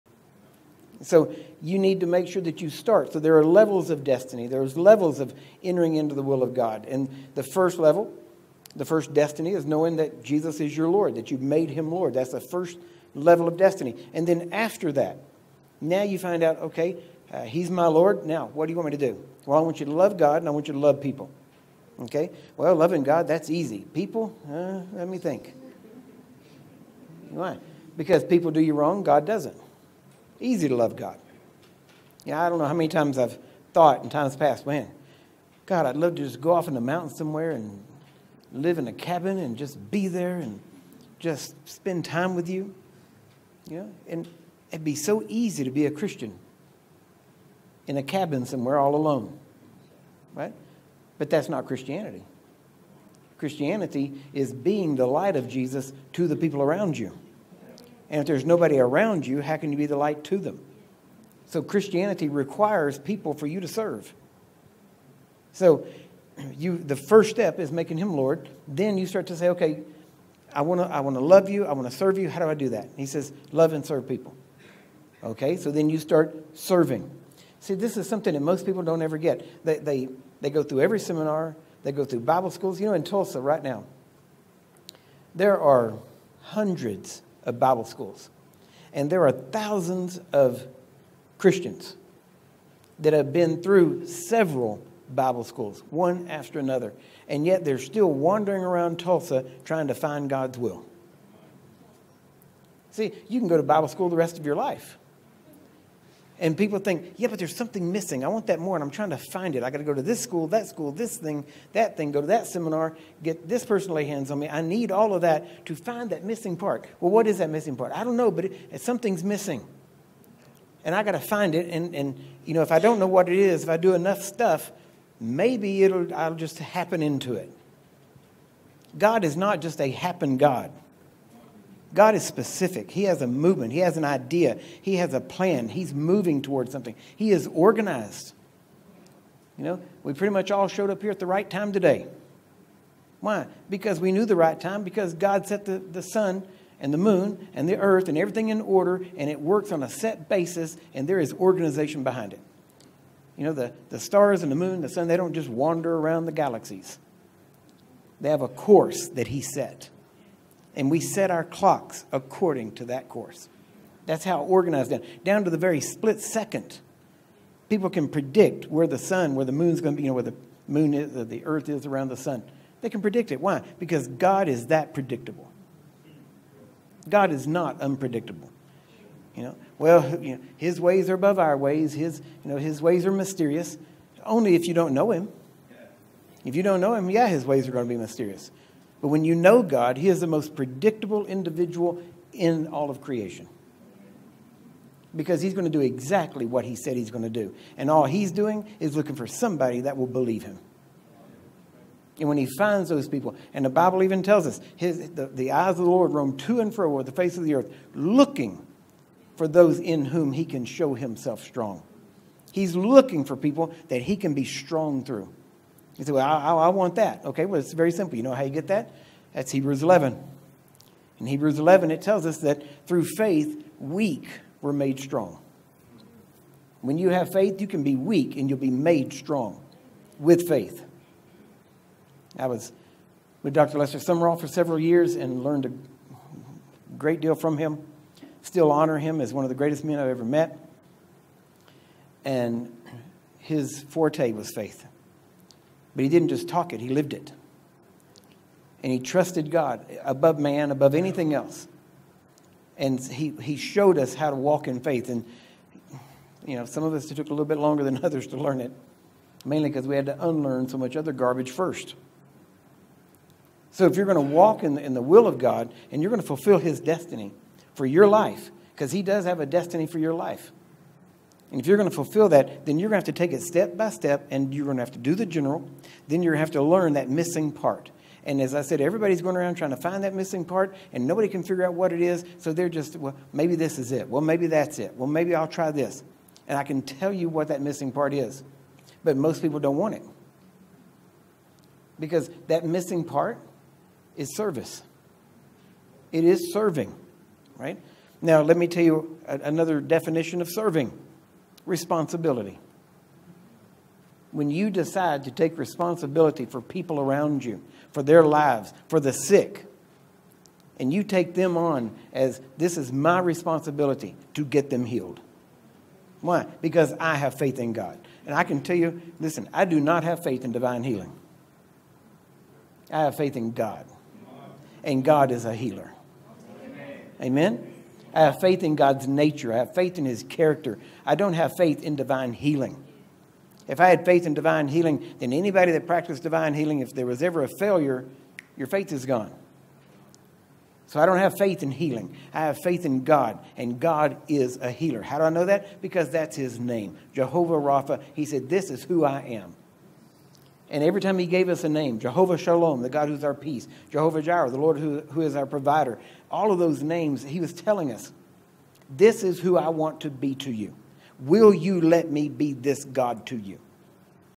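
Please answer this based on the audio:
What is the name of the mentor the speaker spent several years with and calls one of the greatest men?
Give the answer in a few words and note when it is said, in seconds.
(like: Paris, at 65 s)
Dr. Lester Sumrall, at 233 s.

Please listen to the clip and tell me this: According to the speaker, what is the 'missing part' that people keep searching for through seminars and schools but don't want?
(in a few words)
Service.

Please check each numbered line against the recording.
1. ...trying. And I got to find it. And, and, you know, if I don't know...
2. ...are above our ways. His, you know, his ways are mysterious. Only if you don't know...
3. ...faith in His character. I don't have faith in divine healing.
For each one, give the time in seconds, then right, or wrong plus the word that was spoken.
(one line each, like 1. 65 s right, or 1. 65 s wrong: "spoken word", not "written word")
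1. 119 s wrong: "missing", not "trying"
2. 181 s right
3. 329 s right.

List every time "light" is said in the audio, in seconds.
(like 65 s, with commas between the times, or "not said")
55 s, 59 s.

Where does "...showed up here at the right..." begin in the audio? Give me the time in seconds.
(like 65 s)
140 s.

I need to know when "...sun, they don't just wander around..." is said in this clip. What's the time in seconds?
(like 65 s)
154 s.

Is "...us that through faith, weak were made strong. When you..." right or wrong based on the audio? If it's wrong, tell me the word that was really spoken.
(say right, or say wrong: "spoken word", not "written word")
right.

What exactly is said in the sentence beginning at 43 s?
You know, and it'd be so easy to be a Christian in a cabin somewhere all alone, right?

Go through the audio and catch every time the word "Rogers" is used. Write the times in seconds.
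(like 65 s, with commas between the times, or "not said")
not said.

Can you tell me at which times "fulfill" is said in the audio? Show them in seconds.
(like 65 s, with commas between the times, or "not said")
266 s, 271 s.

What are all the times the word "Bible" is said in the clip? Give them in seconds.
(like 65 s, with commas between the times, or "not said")
82 s, 87 s, 95 s, 103 s, 203 s.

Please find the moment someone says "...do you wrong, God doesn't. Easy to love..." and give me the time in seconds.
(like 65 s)
28 s.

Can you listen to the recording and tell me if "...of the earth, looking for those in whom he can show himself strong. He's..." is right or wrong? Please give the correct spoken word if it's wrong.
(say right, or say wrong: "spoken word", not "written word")
right.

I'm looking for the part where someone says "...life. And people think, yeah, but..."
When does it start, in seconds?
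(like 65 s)
104 s.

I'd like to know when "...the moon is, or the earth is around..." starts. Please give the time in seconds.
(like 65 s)
170 s.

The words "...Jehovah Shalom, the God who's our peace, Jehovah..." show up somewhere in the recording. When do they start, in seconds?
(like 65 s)
351 s.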